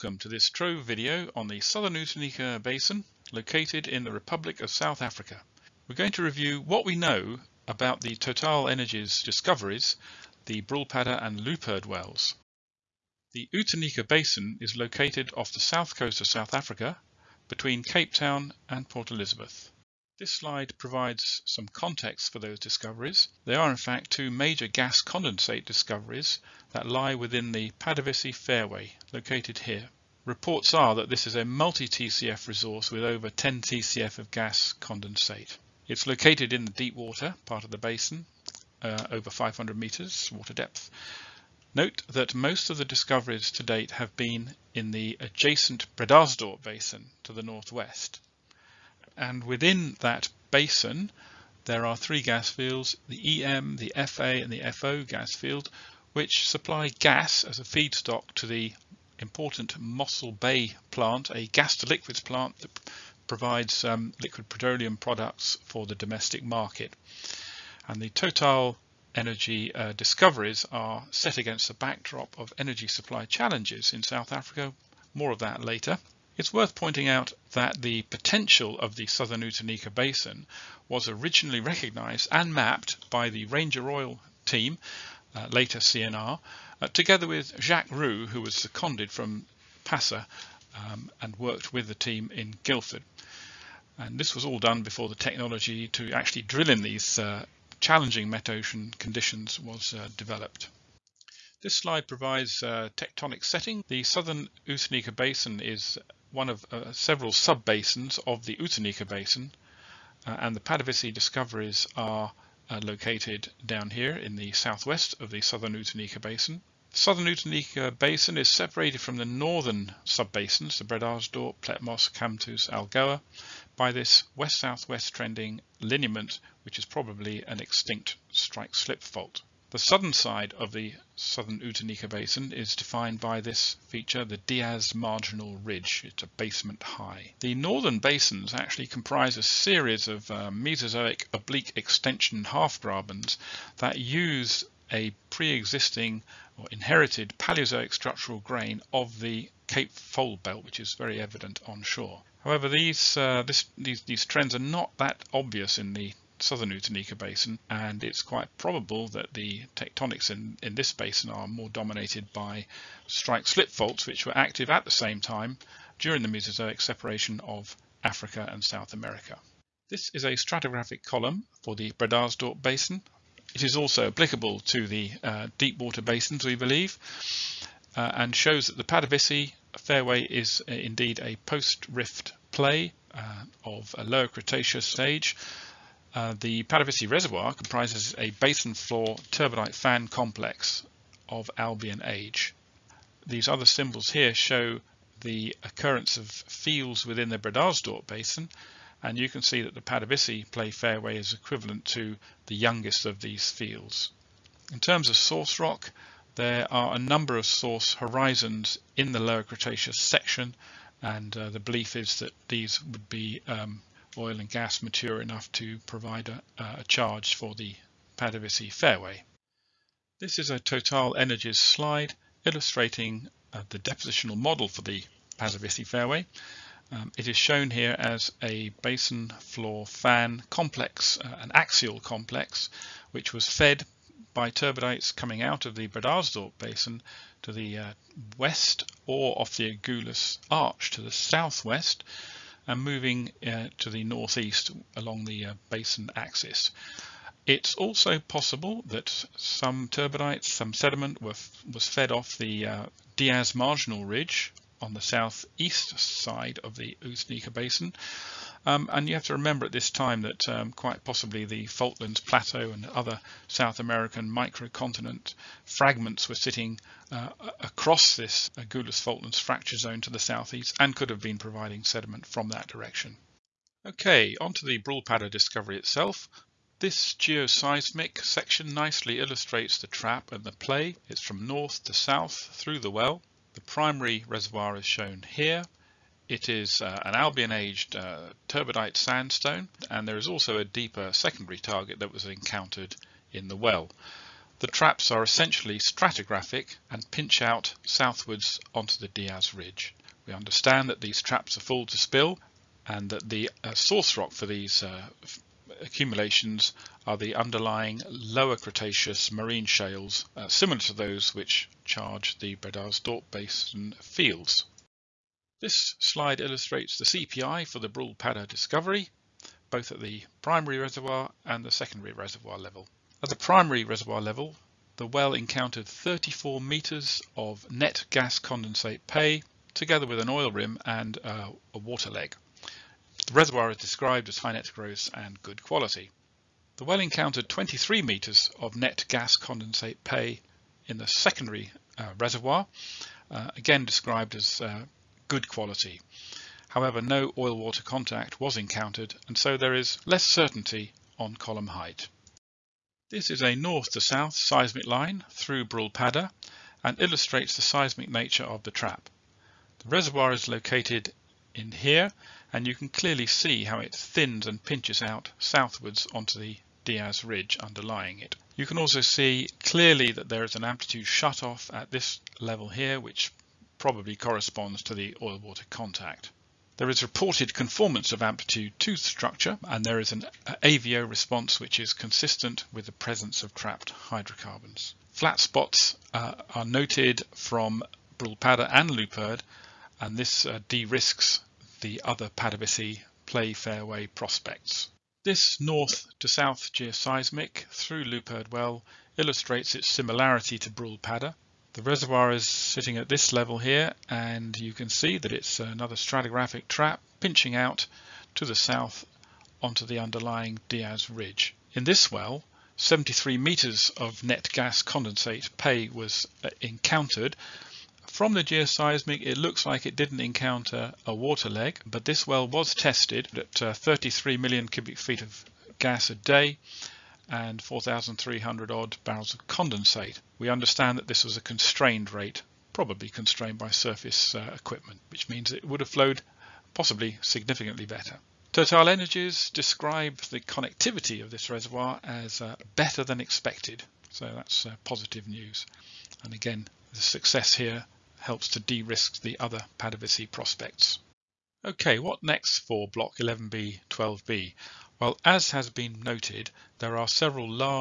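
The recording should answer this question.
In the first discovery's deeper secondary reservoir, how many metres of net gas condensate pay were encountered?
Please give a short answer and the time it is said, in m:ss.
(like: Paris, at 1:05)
23 metres, at 5:37.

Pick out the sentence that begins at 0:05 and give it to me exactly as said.
We're going to review what we know about the Total Energies discoveries, the Brulpadda and Luiperd wells.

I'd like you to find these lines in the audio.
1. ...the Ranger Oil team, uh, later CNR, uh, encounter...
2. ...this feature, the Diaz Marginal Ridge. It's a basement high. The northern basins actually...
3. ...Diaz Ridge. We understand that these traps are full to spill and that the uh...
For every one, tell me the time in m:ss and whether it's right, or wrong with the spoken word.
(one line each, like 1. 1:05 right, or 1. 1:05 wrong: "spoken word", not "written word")
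1. 1:23 wrong: "together", not "encounter"
2. 2:13 right
3. 4:59 right.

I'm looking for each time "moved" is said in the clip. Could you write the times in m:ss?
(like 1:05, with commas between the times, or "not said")
not said.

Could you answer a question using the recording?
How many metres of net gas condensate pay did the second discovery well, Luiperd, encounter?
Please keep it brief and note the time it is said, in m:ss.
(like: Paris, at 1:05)
73 meters, at 6:52.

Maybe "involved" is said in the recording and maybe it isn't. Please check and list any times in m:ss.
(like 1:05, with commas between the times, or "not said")
not said.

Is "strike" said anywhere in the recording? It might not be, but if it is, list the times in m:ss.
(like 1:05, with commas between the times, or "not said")
2:08, 2:43.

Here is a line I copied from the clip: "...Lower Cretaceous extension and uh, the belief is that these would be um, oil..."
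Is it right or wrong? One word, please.
wrong.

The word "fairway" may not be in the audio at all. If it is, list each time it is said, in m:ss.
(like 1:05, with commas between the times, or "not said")
0:28, 2:59, 3:20, 3:38, 3:45, 6:33.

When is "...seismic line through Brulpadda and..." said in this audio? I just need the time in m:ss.
5:54.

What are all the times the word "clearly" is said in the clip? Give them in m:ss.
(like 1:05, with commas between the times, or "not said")
6:02, 6:09.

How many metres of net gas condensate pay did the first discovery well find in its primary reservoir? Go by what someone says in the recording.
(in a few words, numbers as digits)
34 metres.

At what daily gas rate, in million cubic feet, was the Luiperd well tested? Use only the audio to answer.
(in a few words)
33 million cubic feet.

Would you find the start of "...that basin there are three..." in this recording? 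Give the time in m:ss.
0:50.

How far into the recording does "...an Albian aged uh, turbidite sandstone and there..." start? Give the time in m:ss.
4:47.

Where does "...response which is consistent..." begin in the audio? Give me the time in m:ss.
6:21.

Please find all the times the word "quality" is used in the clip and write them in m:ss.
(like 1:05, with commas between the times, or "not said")
5:35, 5:45.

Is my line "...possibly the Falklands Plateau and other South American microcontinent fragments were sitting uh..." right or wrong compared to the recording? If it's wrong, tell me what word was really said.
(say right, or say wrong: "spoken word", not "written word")
right.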